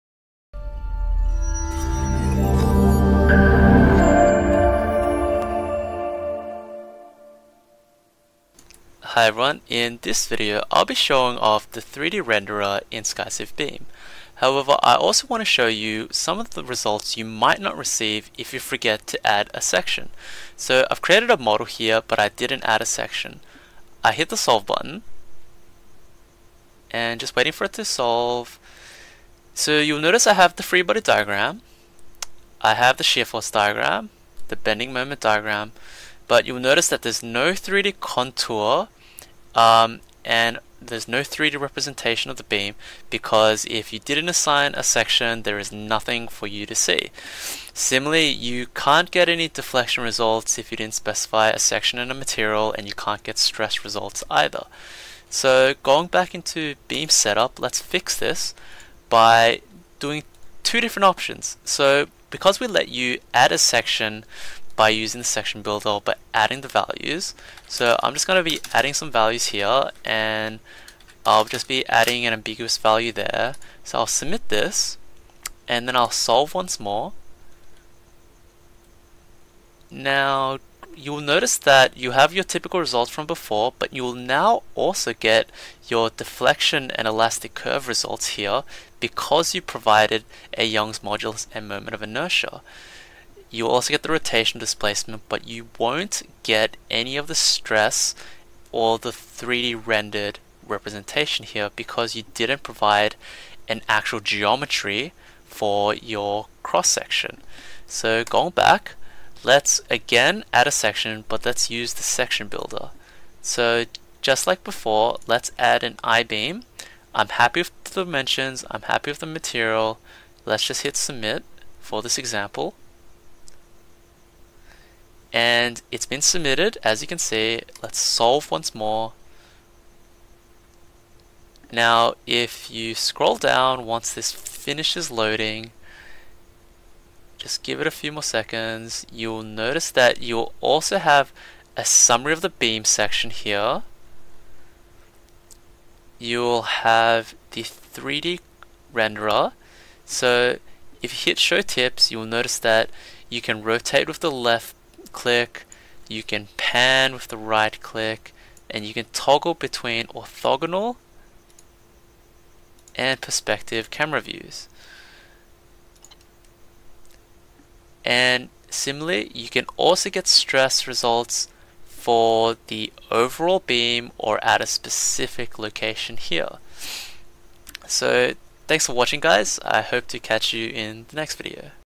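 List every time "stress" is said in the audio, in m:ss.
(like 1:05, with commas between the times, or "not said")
0:53, 1:37, 2:50.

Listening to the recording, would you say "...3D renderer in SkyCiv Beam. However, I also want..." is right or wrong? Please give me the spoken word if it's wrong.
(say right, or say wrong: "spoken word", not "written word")
right.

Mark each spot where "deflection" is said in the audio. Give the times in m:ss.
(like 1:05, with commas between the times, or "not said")
0:49, 1:26.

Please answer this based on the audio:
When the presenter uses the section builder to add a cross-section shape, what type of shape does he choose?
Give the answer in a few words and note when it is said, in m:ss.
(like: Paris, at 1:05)
I-beam, at 1:56.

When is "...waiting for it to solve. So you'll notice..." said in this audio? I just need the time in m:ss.
0:27.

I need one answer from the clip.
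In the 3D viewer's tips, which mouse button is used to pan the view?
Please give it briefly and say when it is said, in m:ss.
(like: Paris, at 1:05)
Right click, at 2:37.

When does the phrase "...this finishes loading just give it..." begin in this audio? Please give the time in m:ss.
2:14.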